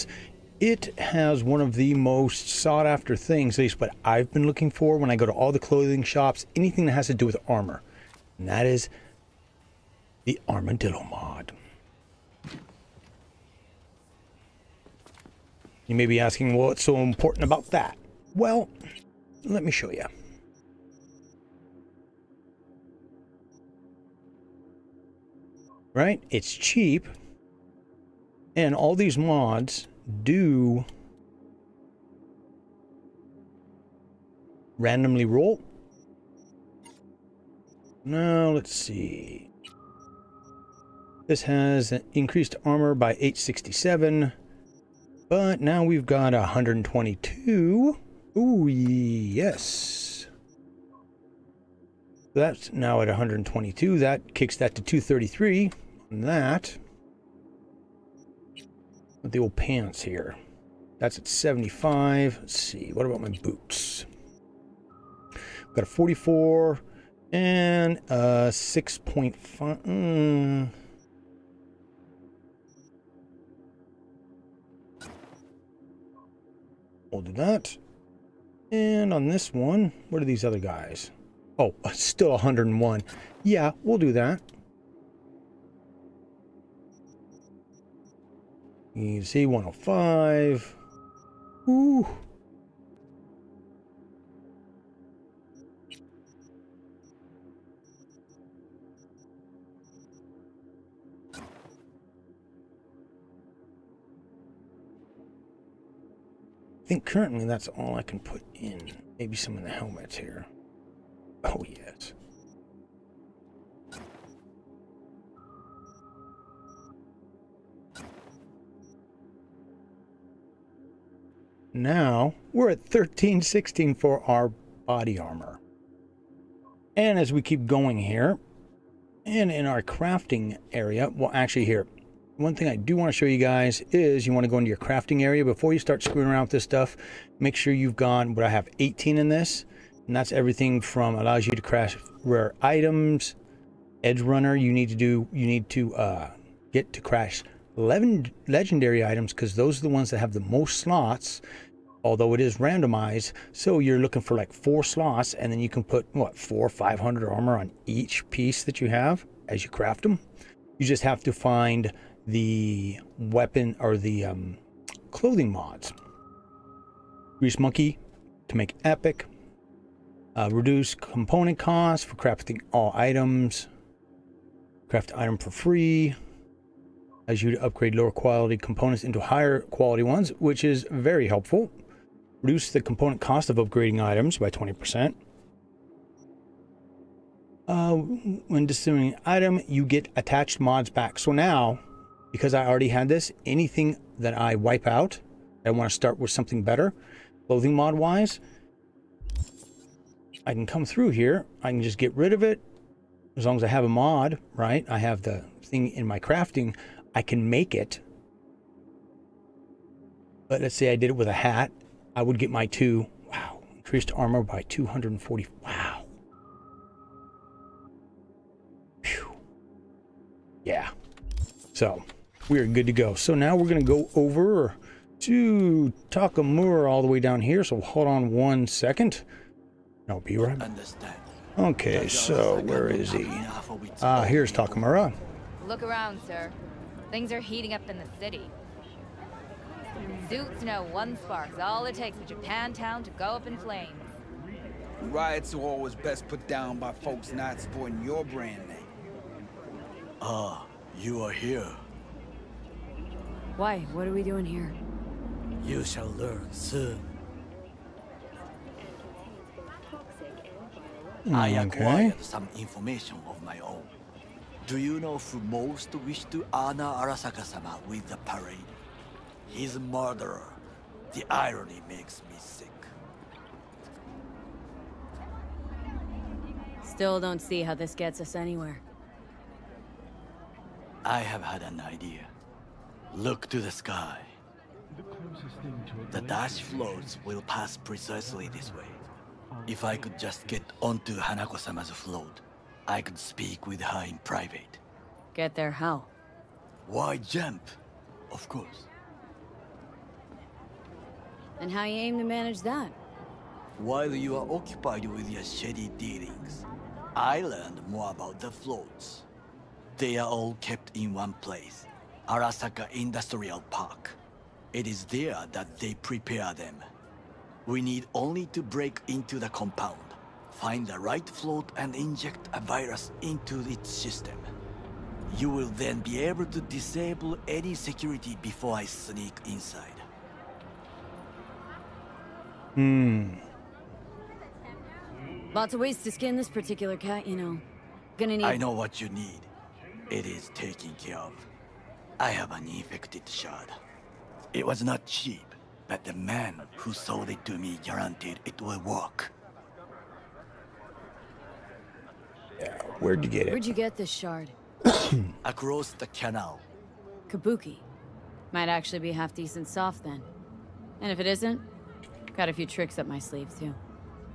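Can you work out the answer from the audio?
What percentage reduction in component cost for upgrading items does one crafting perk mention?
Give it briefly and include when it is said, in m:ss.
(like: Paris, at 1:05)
20%, at 3:04.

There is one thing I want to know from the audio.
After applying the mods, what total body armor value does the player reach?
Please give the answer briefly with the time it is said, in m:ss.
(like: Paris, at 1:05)
1316, at 2:02.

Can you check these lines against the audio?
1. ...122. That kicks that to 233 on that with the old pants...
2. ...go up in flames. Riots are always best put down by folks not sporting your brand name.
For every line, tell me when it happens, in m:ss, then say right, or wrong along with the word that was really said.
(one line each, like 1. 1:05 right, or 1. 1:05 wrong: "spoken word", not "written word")
1. 0:53 right
2. 4:03 right.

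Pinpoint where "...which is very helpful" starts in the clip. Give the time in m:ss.
3:00.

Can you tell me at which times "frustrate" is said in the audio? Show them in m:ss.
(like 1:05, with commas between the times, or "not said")
not said.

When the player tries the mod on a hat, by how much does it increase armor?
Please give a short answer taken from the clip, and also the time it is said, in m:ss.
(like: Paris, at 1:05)
240, at 3:34.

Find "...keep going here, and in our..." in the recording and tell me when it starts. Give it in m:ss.
2:07.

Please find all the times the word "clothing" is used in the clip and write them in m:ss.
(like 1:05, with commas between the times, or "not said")
0:05, 2:45, 3:17.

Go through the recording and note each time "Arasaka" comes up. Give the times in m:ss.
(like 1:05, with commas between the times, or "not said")
4:26, 5:12.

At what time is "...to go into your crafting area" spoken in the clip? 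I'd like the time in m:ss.
2:14.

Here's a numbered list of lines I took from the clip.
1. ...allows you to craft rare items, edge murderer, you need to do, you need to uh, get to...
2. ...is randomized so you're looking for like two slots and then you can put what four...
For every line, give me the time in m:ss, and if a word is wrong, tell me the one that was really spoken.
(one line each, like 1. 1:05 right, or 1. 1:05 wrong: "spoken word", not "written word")
1. 2:21 wrong: "runner", not "murderer"
2. 2:32 wrong: "four", not "two".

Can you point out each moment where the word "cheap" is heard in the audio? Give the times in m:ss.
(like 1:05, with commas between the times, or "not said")
0:26, 5:45.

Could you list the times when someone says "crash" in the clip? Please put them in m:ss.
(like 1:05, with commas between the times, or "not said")
2:27.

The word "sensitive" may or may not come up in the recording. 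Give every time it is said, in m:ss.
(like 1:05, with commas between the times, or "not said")
not said.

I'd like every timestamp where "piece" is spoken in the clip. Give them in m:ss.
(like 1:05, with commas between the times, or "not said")
2:38.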